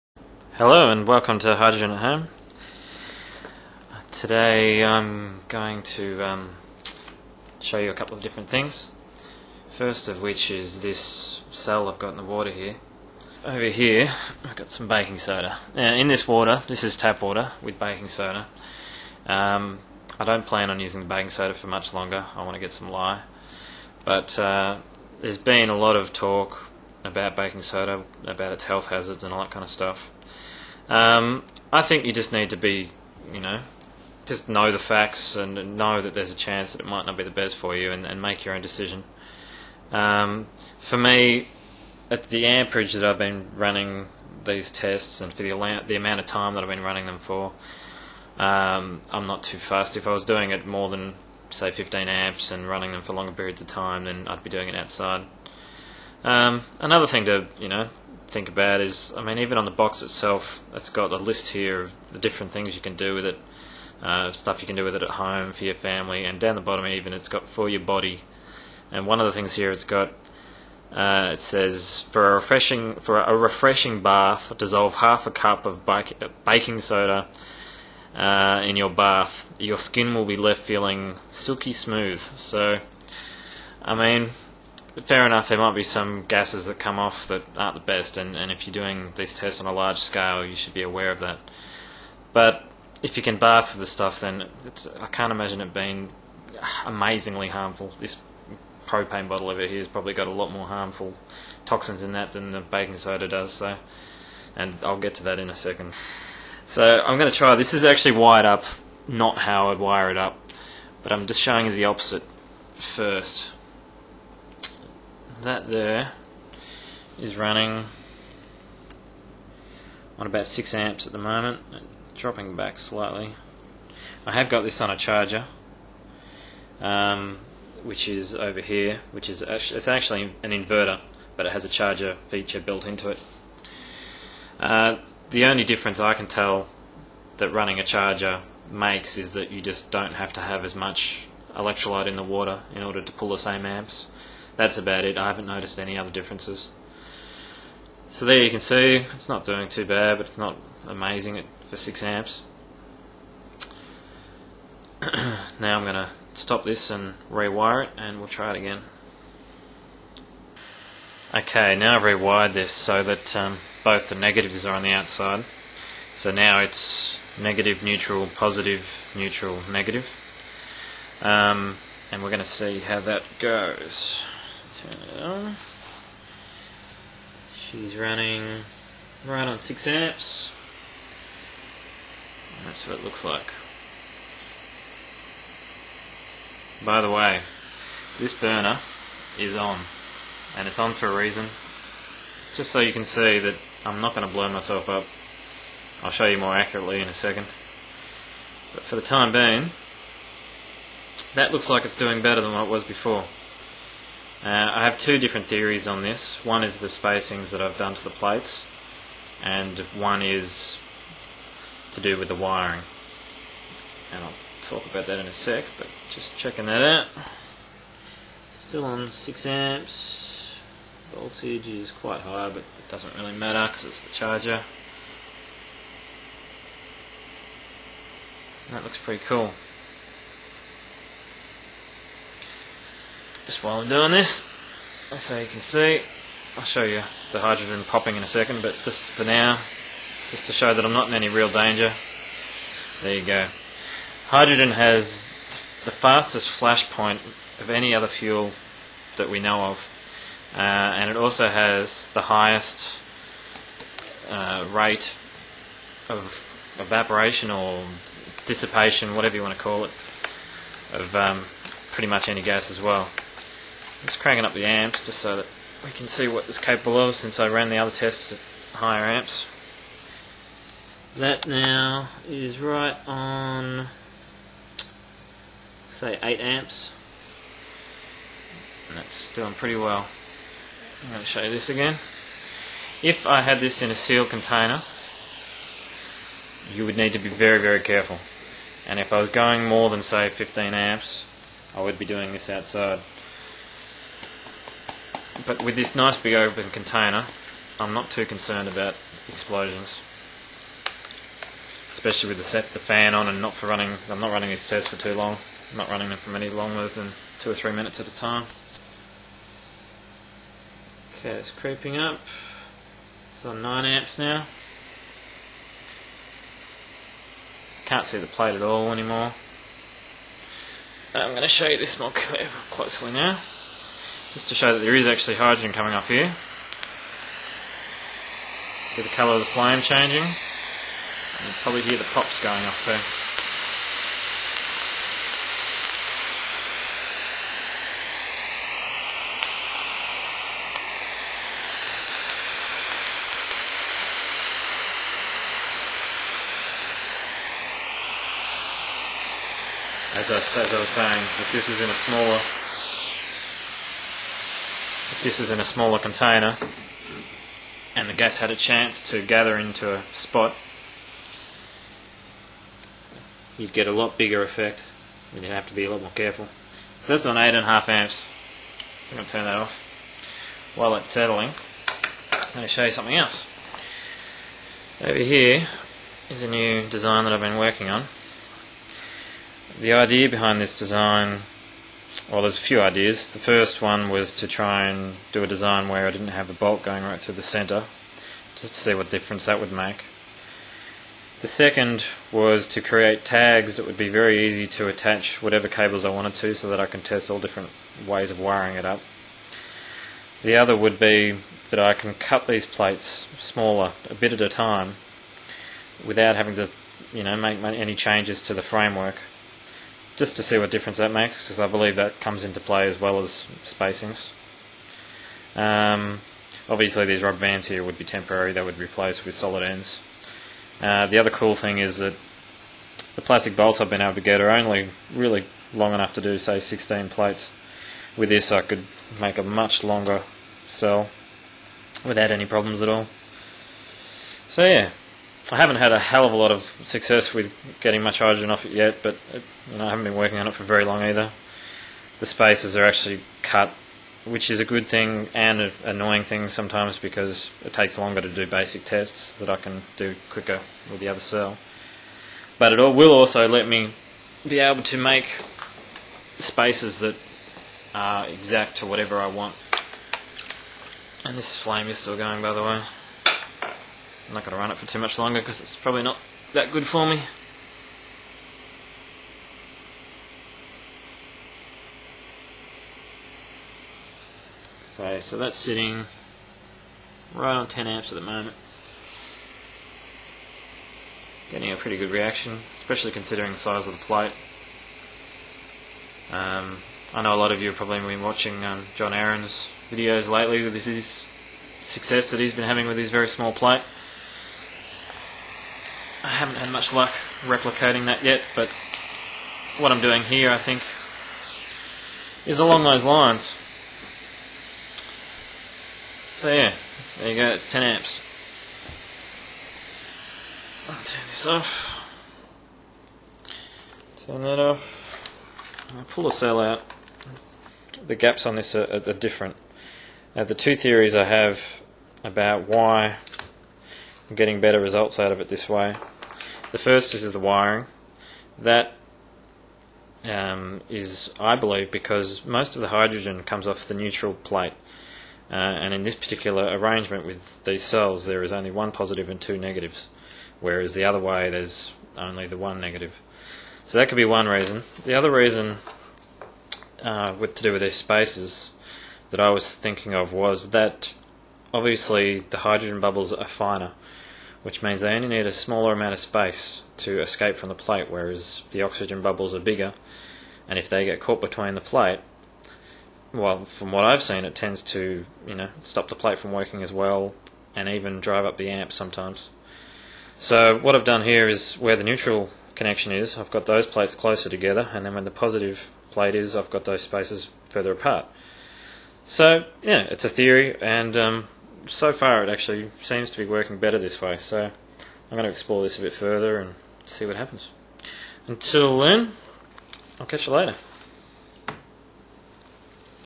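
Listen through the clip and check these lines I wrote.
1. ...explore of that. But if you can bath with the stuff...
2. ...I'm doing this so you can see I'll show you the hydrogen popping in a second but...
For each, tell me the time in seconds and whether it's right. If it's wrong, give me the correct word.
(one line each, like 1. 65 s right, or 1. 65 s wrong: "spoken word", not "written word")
1. 90 s wrong: "aware", not "explore"
2. 233 s right.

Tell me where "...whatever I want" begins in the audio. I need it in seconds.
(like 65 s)
458 s.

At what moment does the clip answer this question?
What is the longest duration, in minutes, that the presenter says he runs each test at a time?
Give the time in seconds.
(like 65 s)
307 s.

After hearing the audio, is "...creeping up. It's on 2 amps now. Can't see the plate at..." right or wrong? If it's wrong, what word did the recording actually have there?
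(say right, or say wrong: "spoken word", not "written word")
wrong: "9", not "2".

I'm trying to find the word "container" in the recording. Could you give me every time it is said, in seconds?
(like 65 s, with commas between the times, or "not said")
284 s, 296 s, 355 s.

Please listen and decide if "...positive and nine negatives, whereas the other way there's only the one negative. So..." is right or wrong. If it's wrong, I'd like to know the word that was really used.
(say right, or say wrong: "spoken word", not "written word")
wrong: "two", not "nine".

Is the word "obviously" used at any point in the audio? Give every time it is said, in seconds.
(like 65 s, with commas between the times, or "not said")
416 s, 551 s.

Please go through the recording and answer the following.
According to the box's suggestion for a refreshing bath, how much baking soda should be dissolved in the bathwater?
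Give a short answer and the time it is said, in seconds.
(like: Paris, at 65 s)
half a cup, at 74 s.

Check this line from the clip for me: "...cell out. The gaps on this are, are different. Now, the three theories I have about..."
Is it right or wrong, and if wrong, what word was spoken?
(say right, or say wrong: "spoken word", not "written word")
wrong: "two", not "three".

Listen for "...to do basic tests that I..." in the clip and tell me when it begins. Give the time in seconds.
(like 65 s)
448 s.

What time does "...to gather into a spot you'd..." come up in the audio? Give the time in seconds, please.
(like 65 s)
359 s.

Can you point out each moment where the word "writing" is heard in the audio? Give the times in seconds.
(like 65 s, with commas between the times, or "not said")
not said.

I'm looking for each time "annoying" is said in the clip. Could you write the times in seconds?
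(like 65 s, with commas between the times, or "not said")
445 s.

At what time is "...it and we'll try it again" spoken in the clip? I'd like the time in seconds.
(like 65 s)
157 s.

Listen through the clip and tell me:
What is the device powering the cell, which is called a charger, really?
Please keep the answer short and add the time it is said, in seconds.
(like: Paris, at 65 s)
an inverter, at 130 s.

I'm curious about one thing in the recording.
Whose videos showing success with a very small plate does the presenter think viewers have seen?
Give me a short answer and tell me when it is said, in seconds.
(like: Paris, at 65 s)
John Aaron, at 488 s.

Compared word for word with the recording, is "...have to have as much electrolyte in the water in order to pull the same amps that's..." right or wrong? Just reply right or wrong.
right.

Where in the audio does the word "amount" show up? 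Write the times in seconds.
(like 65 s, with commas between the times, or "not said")
45 s, 555 s.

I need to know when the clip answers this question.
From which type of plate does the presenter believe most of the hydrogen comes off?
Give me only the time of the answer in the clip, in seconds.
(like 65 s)
533 s.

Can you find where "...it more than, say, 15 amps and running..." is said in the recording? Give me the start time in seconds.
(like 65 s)
50 s.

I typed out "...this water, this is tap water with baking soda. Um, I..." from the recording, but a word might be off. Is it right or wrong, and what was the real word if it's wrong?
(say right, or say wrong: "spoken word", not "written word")
right.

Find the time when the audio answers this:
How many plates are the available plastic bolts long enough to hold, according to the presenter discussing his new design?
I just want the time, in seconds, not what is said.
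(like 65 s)
426 s.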